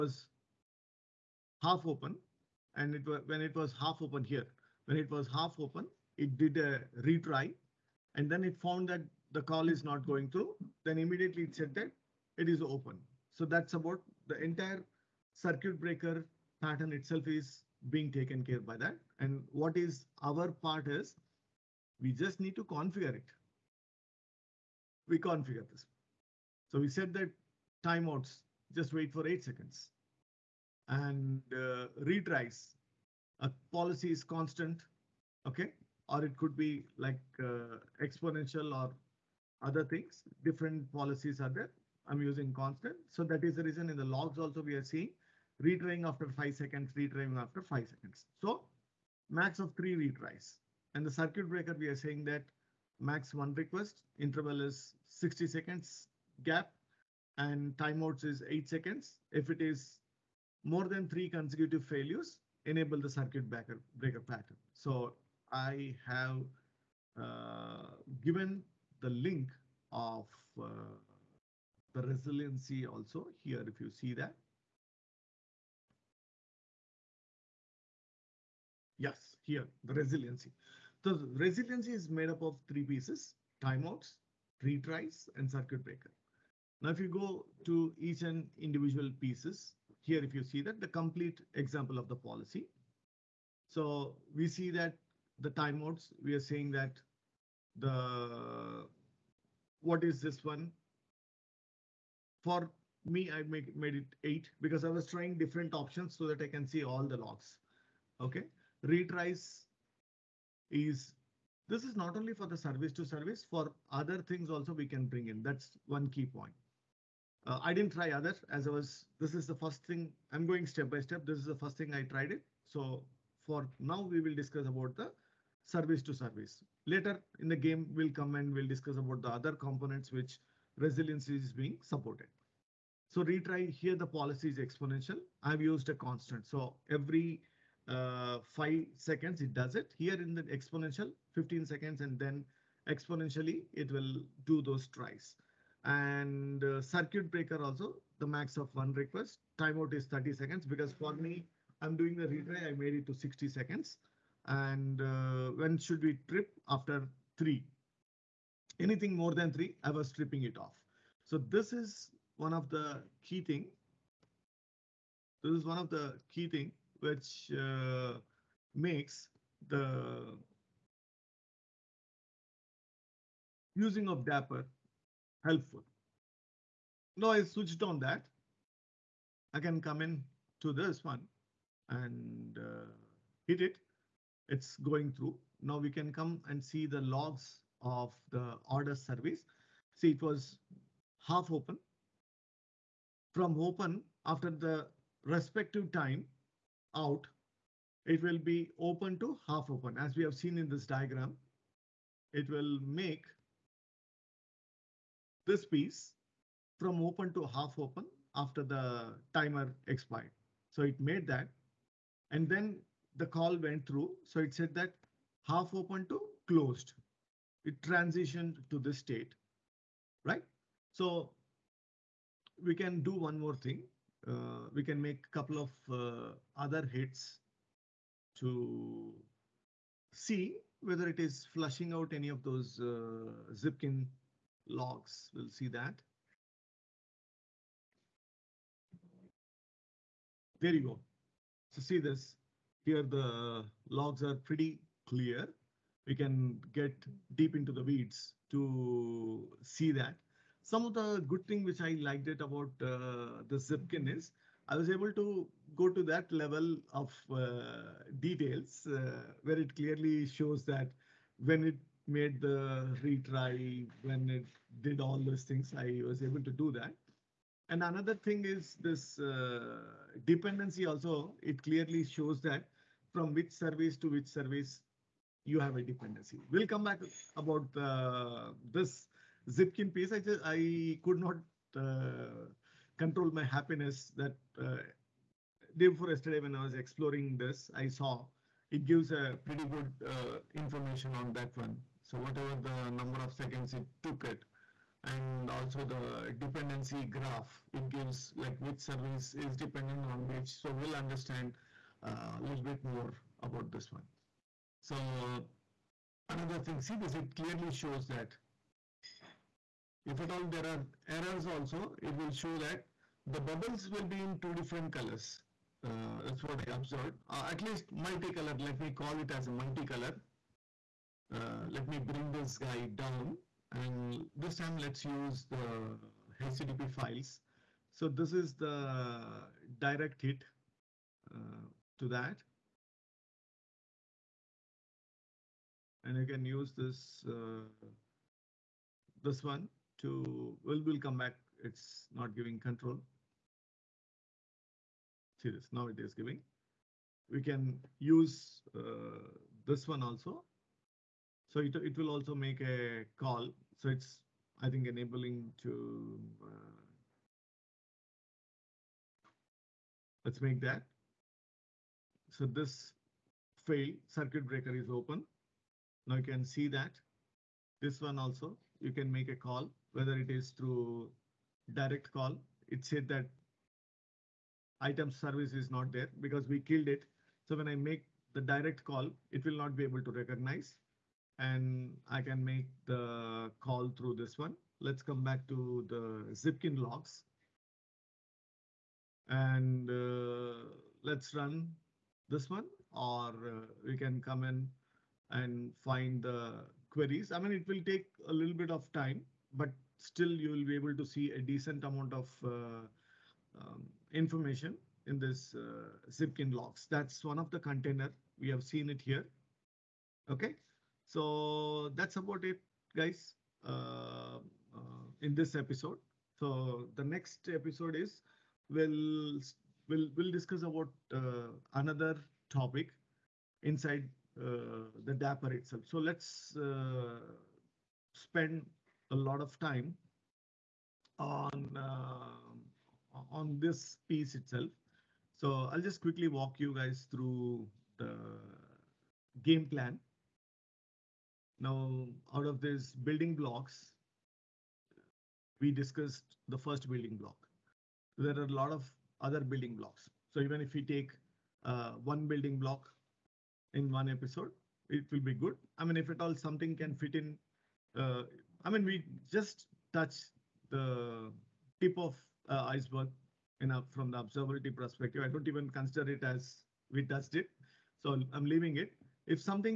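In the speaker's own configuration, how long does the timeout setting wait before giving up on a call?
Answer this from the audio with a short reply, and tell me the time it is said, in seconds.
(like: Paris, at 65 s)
8 seconds, at 28 s.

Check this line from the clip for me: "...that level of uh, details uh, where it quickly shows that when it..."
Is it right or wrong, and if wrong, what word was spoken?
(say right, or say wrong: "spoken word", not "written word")
wrong: "clearly", not "quickly".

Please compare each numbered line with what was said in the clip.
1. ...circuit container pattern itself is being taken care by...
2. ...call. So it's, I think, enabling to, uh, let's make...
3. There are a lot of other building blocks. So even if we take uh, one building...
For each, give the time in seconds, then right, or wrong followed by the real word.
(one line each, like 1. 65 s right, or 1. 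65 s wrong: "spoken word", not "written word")
1. 15 s wrong: "breaker", not "container"
2. 353 s right
3. 448 s right.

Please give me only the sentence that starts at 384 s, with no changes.
Let's come back to the Zipkin logs.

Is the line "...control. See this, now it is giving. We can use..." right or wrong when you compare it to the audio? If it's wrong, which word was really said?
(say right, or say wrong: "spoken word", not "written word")
right.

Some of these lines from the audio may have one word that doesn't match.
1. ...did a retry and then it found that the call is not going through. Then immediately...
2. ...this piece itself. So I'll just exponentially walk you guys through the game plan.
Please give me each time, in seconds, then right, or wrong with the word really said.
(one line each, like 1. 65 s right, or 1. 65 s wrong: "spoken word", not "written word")
1. 6 s right
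2. 433 s wrong: "quickly", not "exponentially".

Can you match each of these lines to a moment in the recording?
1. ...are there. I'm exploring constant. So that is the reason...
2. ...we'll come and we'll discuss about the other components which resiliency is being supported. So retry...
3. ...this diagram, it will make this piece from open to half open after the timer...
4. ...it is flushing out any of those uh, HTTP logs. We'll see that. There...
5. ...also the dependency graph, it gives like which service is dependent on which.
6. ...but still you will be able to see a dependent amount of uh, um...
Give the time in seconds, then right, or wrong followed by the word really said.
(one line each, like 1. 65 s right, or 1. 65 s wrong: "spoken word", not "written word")
1. 41 s wrong: "using", not "exploring"
2. 127 s right
3. 200 s right
4. 231 s wrong: "Zipkin", not "HTTP"
5. 295 s right
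6. 399 s wrong: "decent", not "dependent".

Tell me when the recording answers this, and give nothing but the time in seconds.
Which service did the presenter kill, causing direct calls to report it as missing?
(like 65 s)
374 s.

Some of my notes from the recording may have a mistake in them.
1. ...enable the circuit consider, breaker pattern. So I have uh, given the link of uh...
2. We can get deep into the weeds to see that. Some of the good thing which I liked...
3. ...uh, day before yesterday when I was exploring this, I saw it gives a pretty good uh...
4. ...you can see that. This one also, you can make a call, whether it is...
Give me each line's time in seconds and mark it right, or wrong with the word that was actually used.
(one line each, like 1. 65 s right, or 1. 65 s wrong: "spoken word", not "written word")
1. 62 s wrong: "breaker", not "consider"
2. 246 s right
3. 284 s right
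4. 366 s right.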